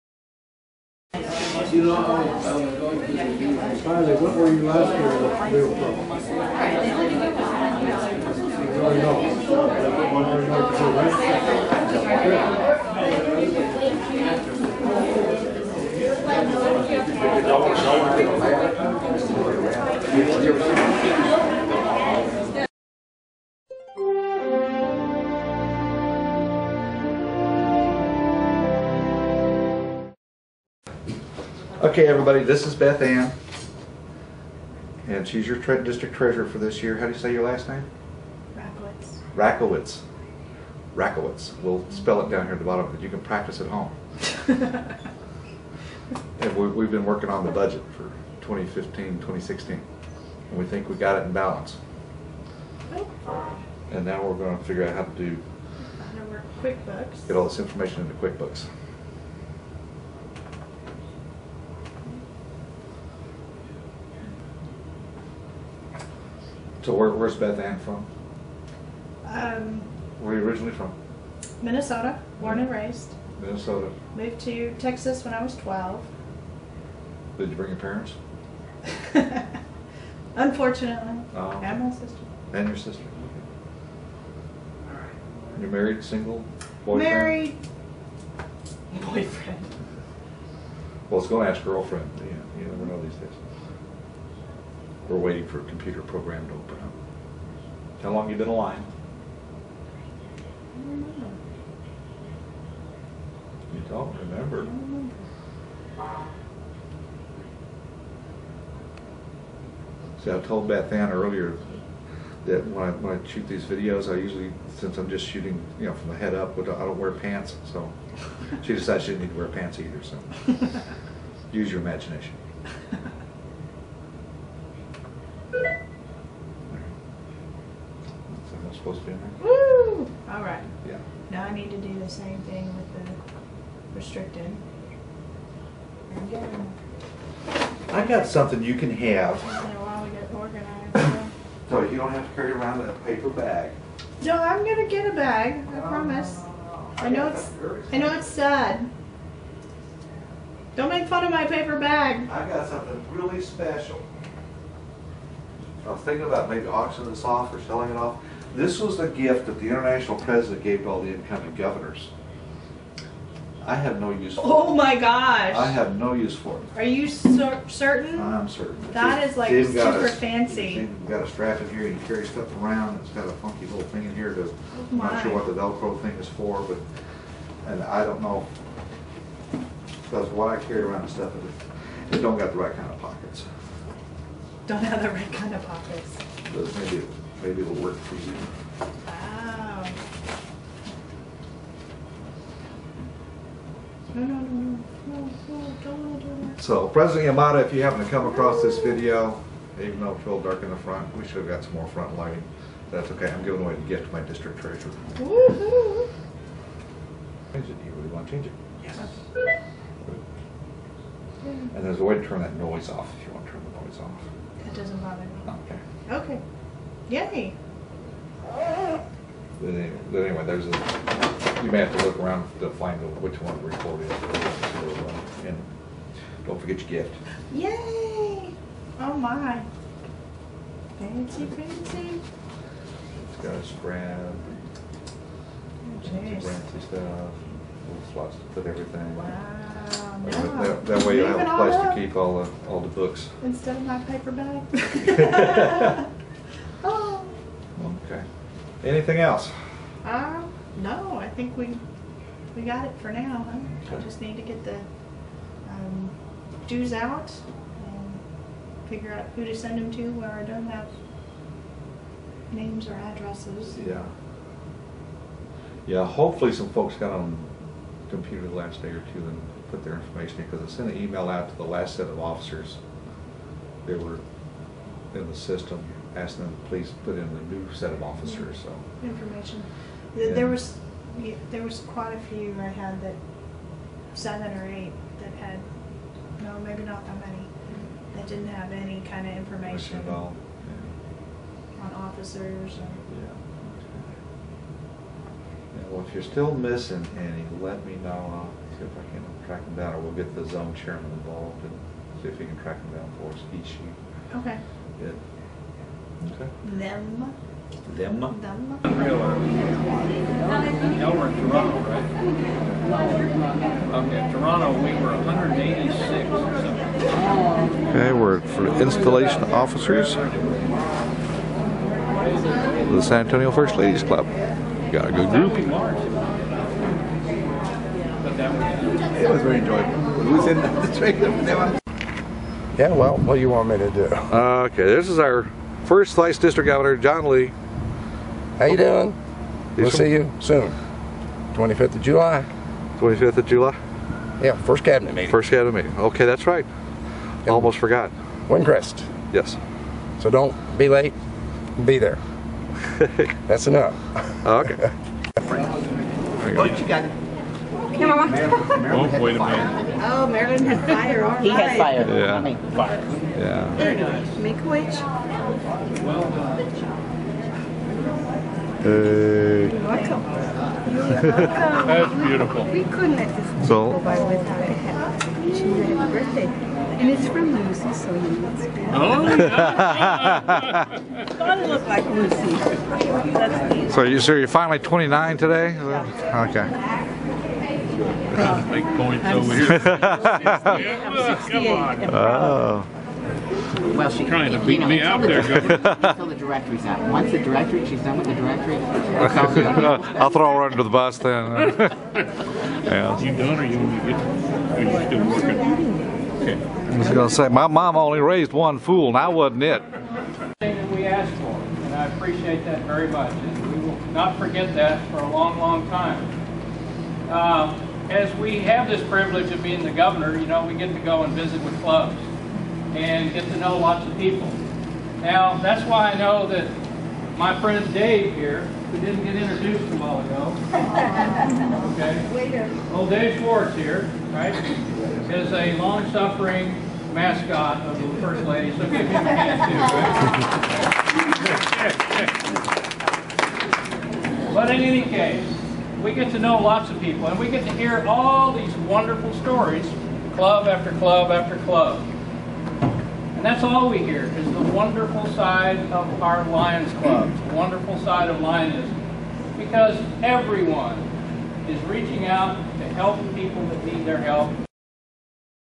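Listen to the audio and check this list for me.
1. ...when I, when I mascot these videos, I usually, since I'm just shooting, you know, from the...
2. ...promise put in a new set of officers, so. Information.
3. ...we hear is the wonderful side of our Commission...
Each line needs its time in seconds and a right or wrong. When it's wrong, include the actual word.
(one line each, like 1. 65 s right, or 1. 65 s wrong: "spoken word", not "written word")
1. 112 s wrong: "shoot", not "mascot"
2. 276 s wrong: "please", not "promise"
3. 453 s wrong: "Lions", not "Commission".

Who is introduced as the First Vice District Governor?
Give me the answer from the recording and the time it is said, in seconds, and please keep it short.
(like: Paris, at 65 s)
John Lee, at 336 s.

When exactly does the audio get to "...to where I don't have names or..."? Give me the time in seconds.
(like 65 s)
259 s.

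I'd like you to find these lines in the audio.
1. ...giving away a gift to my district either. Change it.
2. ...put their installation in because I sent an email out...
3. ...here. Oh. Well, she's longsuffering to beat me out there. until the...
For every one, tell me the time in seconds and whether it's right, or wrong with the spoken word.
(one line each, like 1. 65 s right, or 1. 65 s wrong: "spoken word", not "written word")
1. 203 s wrong: "treasurer", not "either"
2. 269 s wrong: "information", not "installation"
3. 389 s wrong: "trying", not "longsuffering".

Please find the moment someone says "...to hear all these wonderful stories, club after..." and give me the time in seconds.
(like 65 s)
447 s.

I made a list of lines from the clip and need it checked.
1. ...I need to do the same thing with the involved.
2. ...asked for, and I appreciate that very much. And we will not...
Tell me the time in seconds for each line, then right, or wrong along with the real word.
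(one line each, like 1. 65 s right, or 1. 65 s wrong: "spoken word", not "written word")
1. 131 s wrong: "restricted", not "involved"
2. 411 s right.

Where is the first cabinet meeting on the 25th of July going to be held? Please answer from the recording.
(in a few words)
Windcrest.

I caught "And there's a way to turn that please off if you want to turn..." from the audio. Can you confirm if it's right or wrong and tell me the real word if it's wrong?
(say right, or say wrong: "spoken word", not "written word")
wrong: "noise", not "please".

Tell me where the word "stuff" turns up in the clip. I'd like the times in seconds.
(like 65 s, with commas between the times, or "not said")
172 s, 181 s, 236 s.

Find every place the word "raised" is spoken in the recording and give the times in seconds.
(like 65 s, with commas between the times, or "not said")
72 s, 408 s.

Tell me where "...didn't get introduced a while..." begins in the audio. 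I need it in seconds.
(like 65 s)
428 s.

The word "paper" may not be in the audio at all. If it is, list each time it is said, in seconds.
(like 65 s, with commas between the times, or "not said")
143 s, 151 s, 244 s.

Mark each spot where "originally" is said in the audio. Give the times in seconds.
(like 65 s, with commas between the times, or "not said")
70 s.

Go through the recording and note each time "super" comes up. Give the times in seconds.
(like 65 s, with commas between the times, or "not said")
169 s.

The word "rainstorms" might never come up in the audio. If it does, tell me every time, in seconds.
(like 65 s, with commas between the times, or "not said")
not said.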